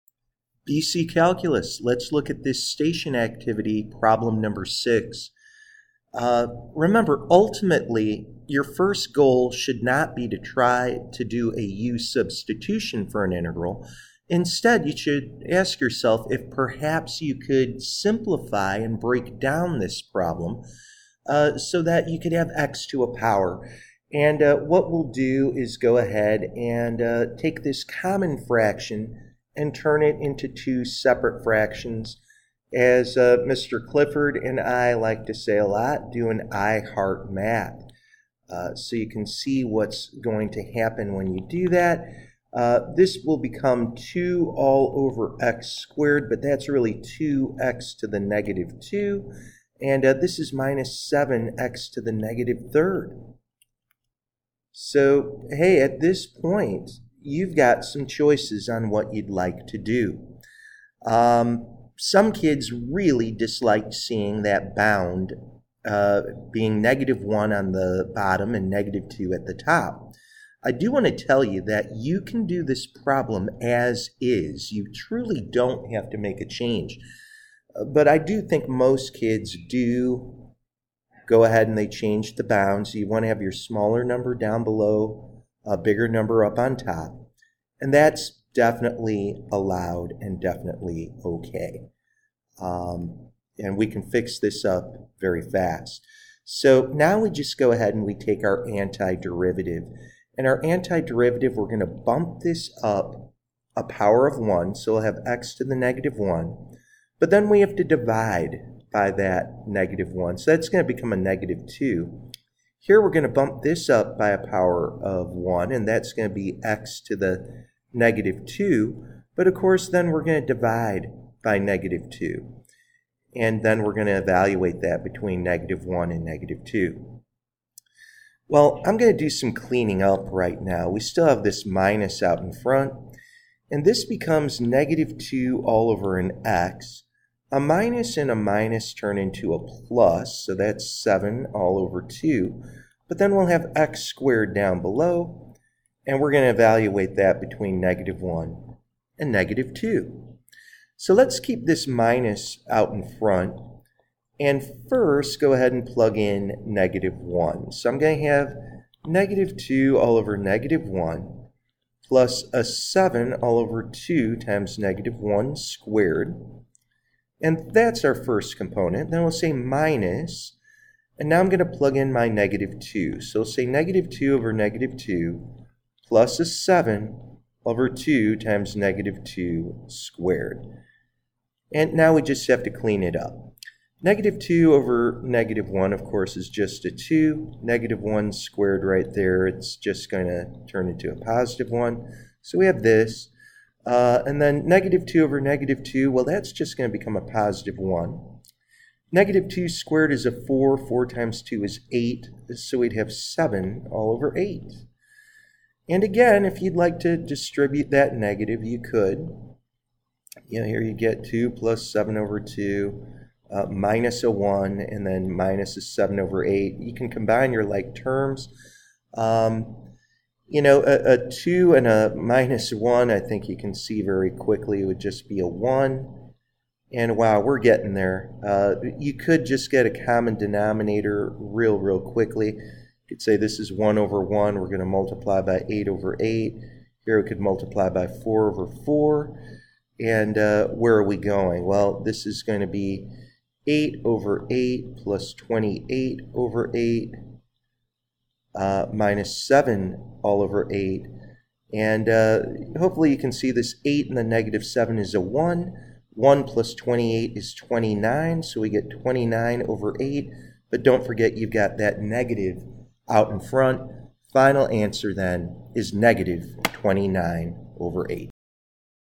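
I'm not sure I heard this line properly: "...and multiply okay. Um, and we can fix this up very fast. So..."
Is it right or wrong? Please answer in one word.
wrong.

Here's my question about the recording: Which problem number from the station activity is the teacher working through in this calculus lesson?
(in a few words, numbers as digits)
6.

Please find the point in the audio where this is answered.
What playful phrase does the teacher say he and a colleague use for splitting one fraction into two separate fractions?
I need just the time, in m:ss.
0:36.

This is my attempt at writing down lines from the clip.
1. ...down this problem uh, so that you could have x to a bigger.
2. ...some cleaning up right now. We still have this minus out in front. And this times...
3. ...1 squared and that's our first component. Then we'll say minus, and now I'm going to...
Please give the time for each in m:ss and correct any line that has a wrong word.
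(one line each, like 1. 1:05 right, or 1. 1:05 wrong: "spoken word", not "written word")
1. 0:19 wrong: "power", not "bigger"
2. 2:09 wrong: "becomes", not "times"
3. 2:45 right.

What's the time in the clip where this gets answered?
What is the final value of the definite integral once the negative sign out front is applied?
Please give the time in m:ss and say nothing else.
4:25.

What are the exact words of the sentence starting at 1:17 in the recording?
Uh, but I do think most kids do go ahead and they change the bounds.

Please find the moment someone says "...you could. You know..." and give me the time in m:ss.
3:28.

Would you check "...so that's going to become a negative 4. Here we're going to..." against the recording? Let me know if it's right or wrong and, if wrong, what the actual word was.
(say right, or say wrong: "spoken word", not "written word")
wrong: "2", not "4".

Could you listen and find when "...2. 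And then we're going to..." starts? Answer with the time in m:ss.
2:02.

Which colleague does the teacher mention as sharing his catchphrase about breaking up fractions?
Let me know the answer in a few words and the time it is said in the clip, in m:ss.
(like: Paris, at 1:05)
Mr. Clifford, at 0:33.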